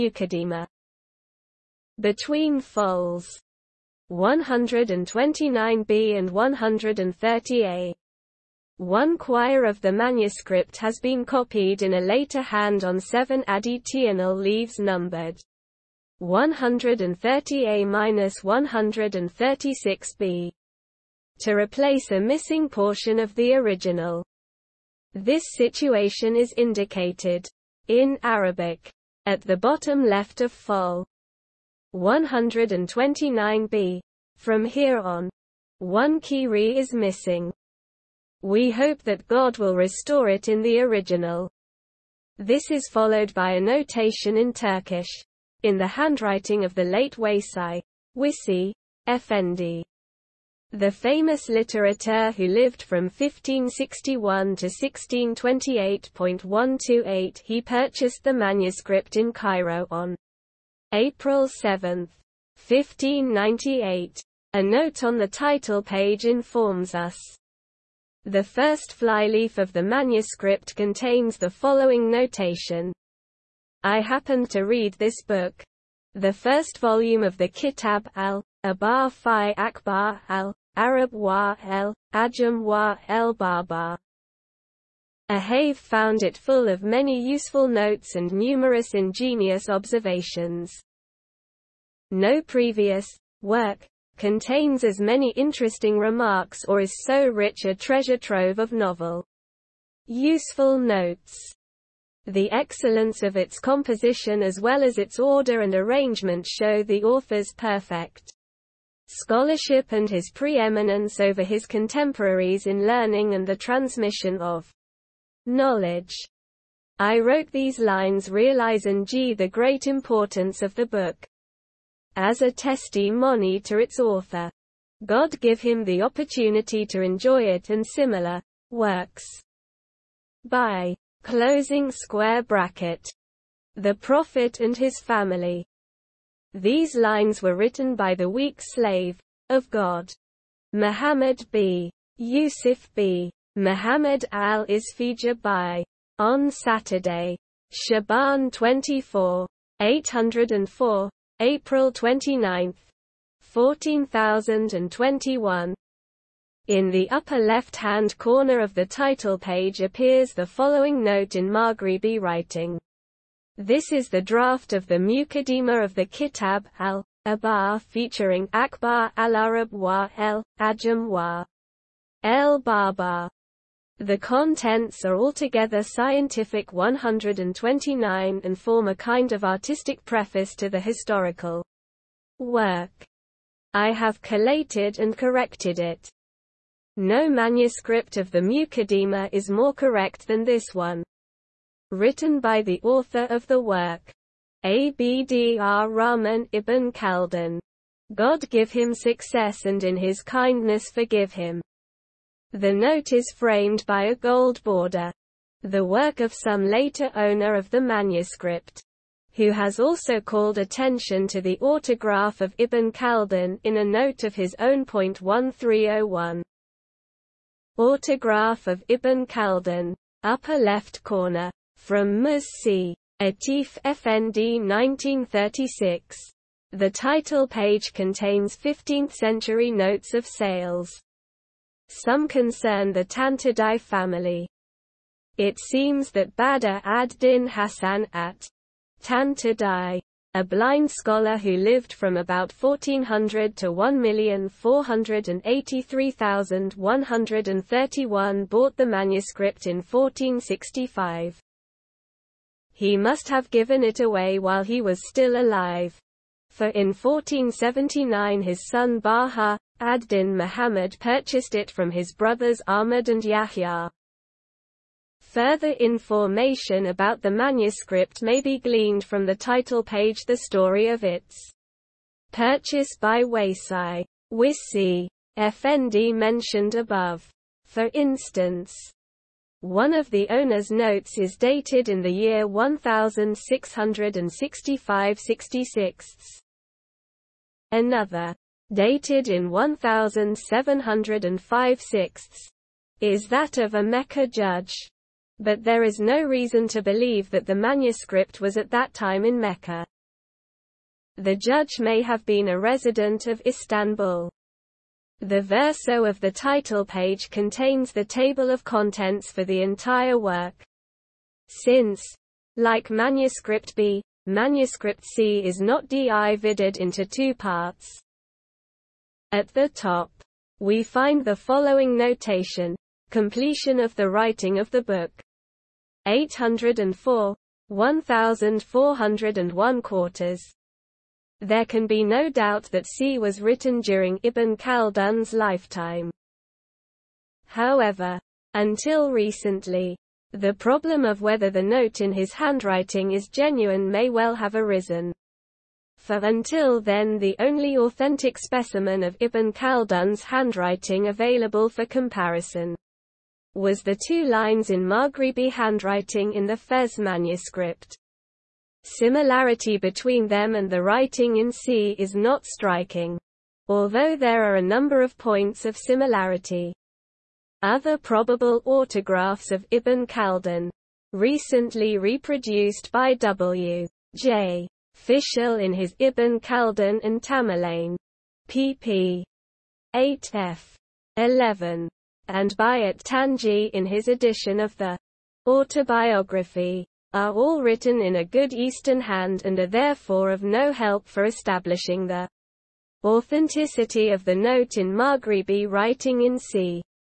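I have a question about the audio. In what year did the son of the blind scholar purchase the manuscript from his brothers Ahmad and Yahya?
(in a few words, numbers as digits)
1479.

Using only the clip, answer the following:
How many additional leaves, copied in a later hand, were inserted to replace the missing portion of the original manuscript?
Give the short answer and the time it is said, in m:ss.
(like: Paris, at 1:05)
7, at 0:12.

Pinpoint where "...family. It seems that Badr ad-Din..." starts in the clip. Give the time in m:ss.
3:53.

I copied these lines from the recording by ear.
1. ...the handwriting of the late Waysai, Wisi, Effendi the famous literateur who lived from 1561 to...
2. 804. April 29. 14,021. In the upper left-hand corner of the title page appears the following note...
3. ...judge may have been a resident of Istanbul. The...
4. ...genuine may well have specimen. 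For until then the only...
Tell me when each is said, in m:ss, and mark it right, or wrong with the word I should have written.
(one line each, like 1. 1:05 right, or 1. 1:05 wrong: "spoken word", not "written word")
1. 0:45 right
2. 2:29 right
3. 5:01 right
4. 5:43 wrong: "arisen", not "specimen".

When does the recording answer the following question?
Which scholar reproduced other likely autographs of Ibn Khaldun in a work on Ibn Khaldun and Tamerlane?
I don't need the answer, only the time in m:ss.
6:13.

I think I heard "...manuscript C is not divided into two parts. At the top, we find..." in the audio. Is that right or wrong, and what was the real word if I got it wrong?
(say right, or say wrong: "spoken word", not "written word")
right.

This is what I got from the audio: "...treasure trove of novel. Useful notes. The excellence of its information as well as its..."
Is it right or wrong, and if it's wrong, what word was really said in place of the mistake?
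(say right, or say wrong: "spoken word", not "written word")
wrong: "composition", not "information".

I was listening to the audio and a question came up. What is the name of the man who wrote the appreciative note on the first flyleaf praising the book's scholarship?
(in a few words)
Muhammad b. Yusuf b. Muhammad al-Isfija.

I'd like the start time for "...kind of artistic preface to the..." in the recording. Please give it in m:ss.
2:58.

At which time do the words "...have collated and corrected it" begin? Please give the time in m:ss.
3:03.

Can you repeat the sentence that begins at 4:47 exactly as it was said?
Another, dated in 1705-6, is that of a Mecca judge.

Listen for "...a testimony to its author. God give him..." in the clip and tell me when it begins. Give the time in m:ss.
2:02.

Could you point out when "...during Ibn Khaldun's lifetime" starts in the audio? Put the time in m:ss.
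5:33.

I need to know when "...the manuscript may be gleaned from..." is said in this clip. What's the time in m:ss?
4:27.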